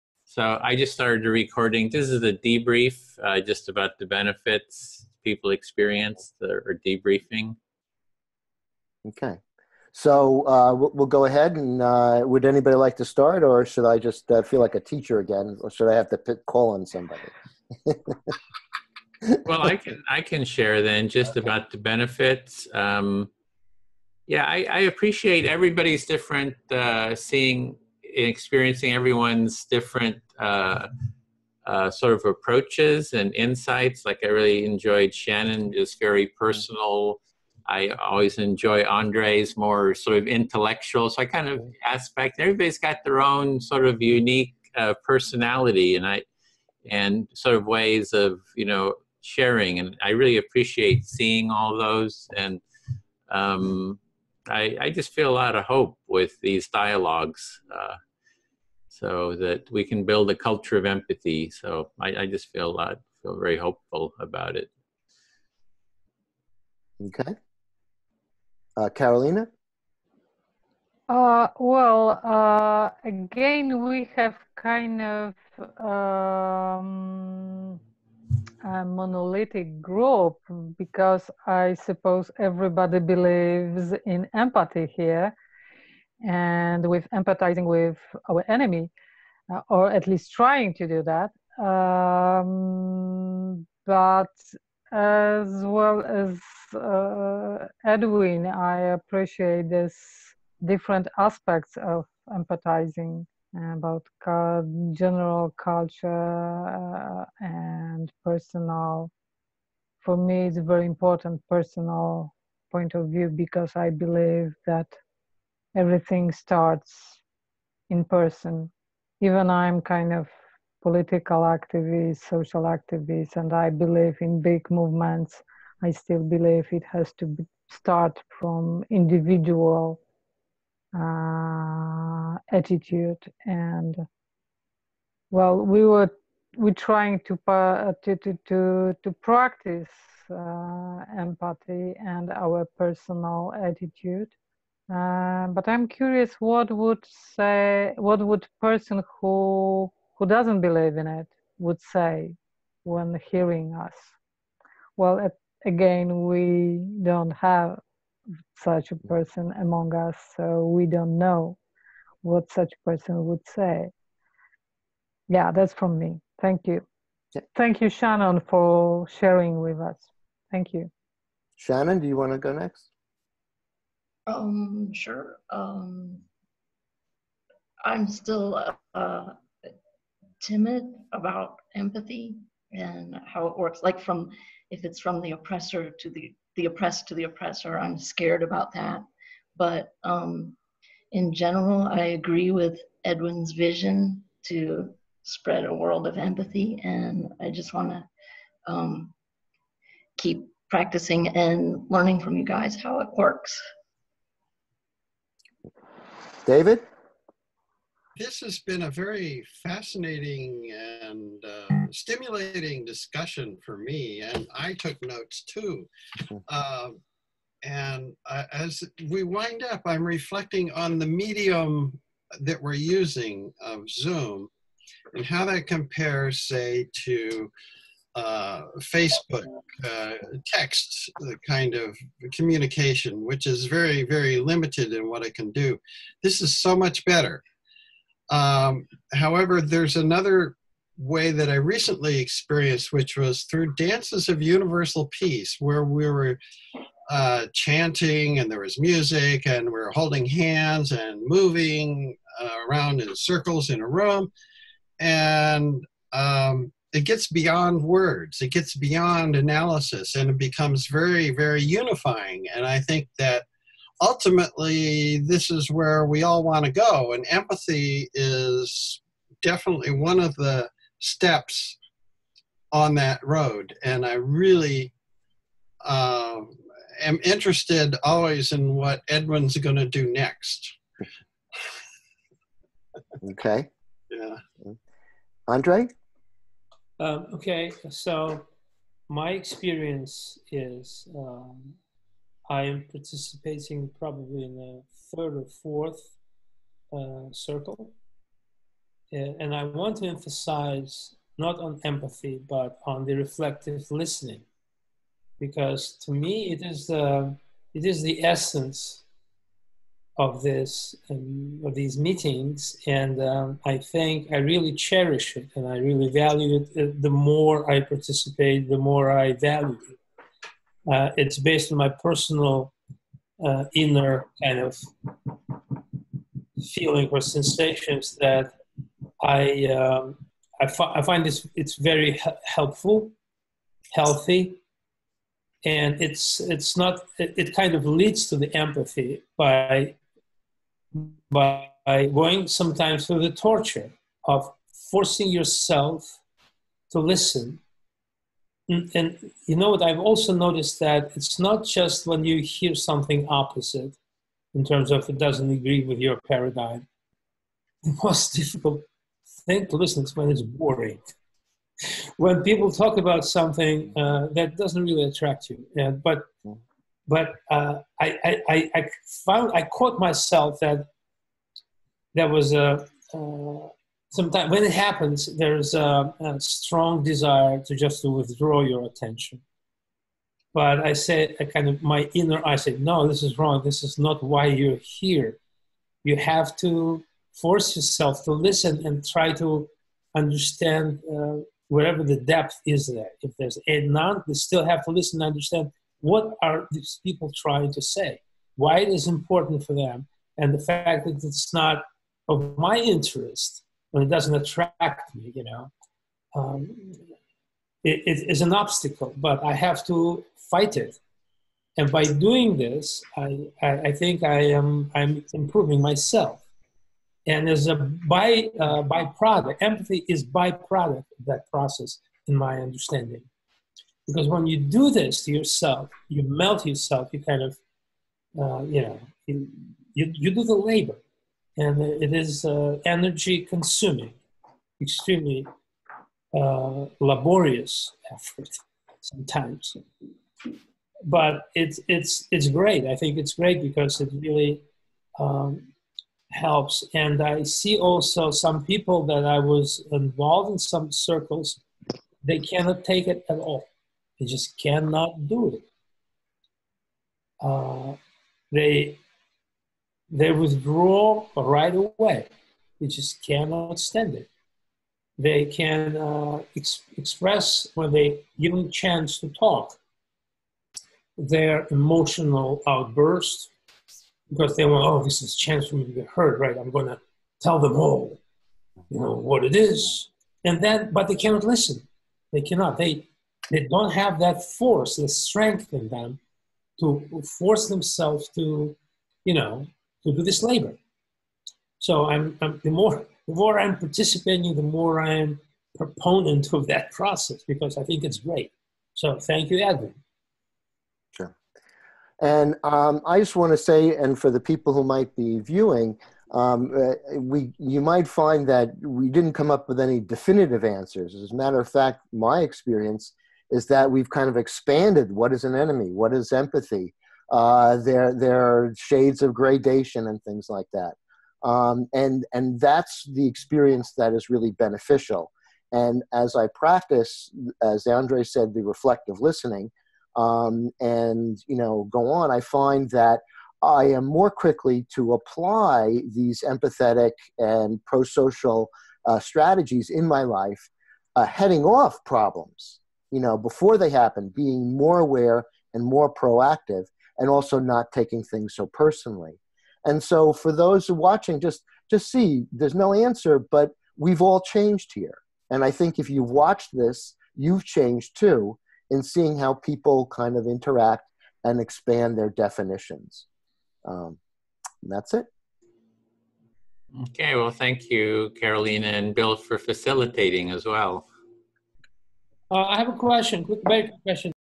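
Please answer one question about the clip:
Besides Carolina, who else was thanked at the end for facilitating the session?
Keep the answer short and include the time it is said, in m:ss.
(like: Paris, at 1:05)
Bill, at 9:29.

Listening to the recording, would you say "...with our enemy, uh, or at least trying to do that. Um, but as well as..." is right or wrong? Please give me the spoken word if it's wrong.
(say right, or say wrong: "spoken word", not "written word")
right.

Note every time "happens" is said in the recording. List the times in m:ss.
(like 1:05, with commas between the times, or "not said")
6:14, 9:03.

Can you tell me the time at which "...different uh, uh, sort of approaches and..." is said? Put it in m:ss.
0:29.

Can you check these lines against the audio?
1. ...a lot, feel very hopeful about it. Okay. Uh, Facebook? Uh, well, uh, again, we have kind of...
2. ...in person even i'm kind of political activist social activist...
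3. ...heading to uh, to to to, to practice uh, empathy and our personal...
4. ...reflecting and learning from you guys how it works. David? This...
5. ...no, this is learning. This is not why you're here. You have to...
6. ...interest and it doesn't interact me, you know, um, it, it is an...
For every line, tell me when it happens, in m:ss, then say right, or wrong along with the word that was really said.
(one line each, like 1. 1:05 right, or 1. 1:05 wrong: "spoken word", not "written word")
1. 1:02 wrong: "Carolina", not "Facebook"
2. 1:57 right
3. 2:16 wrong: "trying", not "heading"
4. 3:20 wrong: "practicing", not "reflecting"
5. 6:22 wrong: "wrong", not "learning"
6. 6:42 wrong: "attract", not "interact".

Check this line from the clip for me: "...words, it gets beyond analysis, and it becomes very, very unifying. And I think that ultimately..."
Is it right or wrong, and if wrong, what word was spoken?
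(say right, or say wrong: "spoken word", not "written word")
right.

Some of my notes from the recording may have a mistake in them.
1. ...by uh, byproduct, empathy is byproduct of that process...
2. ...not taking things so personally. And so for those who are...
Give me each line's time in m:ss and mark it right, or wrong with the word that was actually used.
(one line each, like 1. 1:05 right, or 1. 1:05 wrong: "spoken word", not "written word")
1. 6:57 right
2. 9:07 right.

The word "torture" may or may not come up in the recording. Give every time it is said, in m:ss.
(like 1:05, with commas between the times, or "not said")
5:43.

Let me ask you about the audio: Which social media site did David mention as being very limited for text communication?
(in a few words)
Facebook.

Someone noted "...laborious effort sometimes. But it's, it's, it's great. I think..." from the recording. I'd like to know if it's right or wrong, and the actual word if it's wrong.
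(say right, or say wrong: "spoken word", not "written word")
right.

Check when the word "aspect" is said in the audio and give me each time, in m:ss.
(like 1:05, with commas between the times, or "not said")
0:41, 1:41.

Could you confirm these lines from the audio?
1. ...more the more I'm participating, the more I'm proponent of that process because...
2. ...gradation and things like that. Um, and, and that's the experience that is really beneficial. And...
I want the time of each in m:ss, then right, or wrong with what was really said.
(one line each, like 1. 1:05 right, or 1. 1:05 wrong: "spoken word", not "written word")
1. 8:12 right
2. 8:39 right.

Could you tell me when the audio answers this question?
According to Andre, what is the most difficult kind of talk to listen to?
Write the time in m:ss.
6:00.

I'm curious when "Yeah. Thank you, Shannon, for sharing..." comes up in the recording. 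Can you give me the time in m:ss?
2:47.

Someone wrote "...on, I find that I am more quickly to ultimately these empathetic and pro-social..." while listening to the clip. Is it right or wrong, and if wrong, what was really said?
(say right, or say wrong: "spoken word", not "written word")
wrong: "apply", not "ultimately".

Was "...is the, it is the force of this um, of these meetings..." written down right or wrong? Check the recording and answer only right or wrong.
wrong.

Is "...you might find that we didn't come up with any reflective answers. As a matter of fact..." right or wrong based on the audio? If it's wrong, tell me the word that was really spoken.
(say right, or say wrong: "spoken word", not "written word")
wrong: "definitive", not "reflective".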